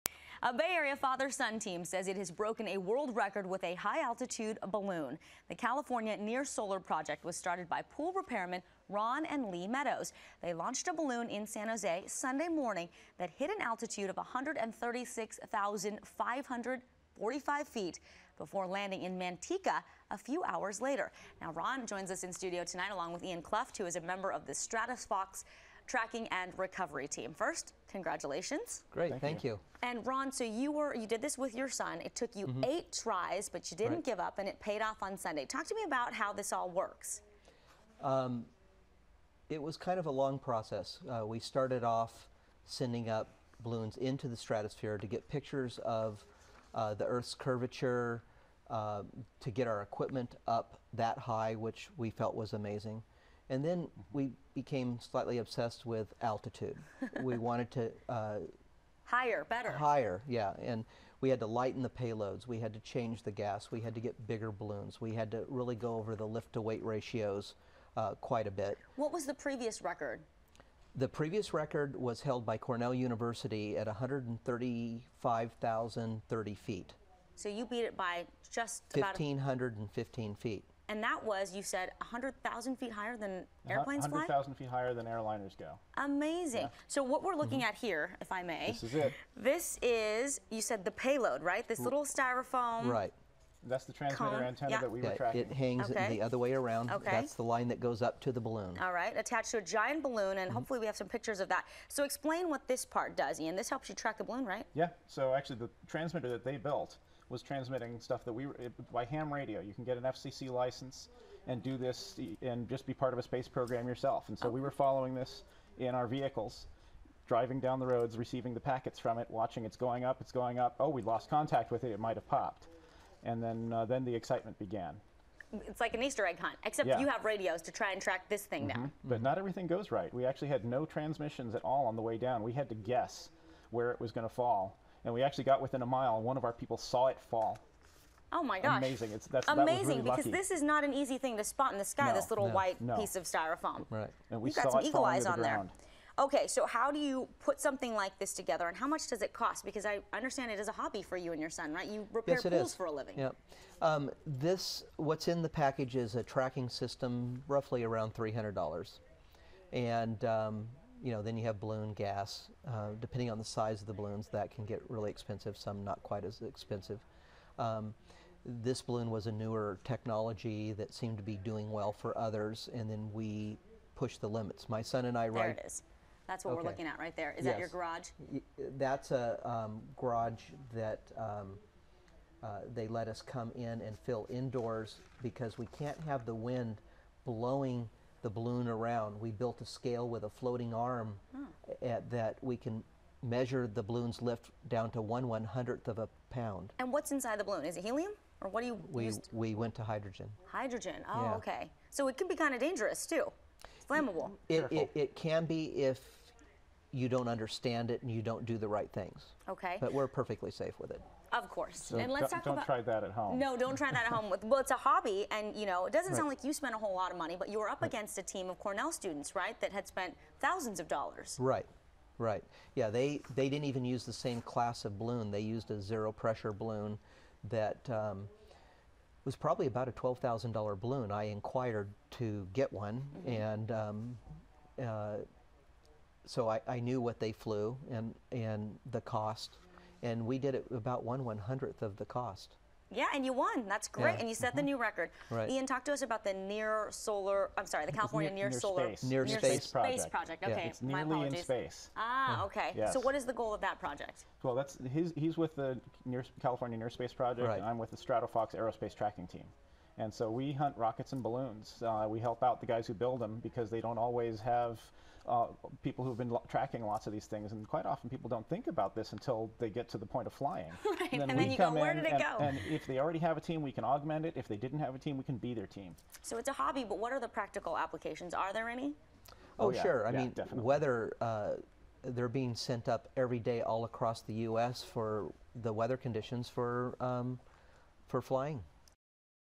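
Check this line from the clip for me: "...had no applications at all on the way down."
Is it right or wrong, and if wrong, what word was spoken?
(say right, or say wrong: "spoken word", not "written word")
wrong: "transmissions", not "applications".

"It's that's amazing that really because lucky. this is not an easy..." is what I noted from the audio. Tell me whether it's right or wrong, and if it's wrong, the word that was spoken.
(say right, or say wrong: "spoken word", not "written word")
right.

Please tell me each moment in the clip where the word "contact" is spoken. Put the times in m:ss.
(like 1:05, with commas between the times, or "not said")
2:01.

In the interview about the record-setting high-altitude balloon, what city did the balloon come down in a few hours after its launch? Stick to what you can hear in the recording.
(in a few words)
Manteca.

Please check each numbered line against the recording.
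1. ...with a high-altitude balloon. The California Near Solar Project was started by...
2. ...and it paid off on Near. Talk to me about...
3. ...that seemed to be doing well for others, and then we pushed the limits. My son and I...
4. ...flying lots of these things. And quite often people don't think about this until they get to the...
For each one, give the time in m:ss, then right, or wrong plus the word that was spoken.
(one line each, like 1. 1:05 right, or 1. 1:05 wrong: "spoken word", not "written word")
1. 0:03 right
2. 0:34 wrong: "Sunday", not "Near"
3. 2:50 right
4. 4:26 wrong: "tracking", not "flying".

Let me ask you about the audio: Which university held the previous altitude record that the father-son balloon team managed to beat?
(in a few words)
Cornell University.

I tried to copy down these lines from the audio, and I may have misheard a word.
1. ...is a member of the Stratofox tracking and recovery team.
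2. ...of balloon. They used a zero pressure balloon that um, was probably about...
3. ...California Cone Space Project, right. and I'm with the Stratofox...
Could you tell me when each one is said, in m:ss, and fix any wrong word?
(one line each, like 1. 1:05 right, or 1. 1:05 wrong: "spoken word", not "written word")
1. 0:23 right
2. 3:44 right
3. 4:16 wrong: "Near", not "Cone".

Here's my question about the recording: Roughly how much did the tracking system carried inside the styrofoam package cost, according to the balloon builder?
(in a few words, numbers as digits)
$300.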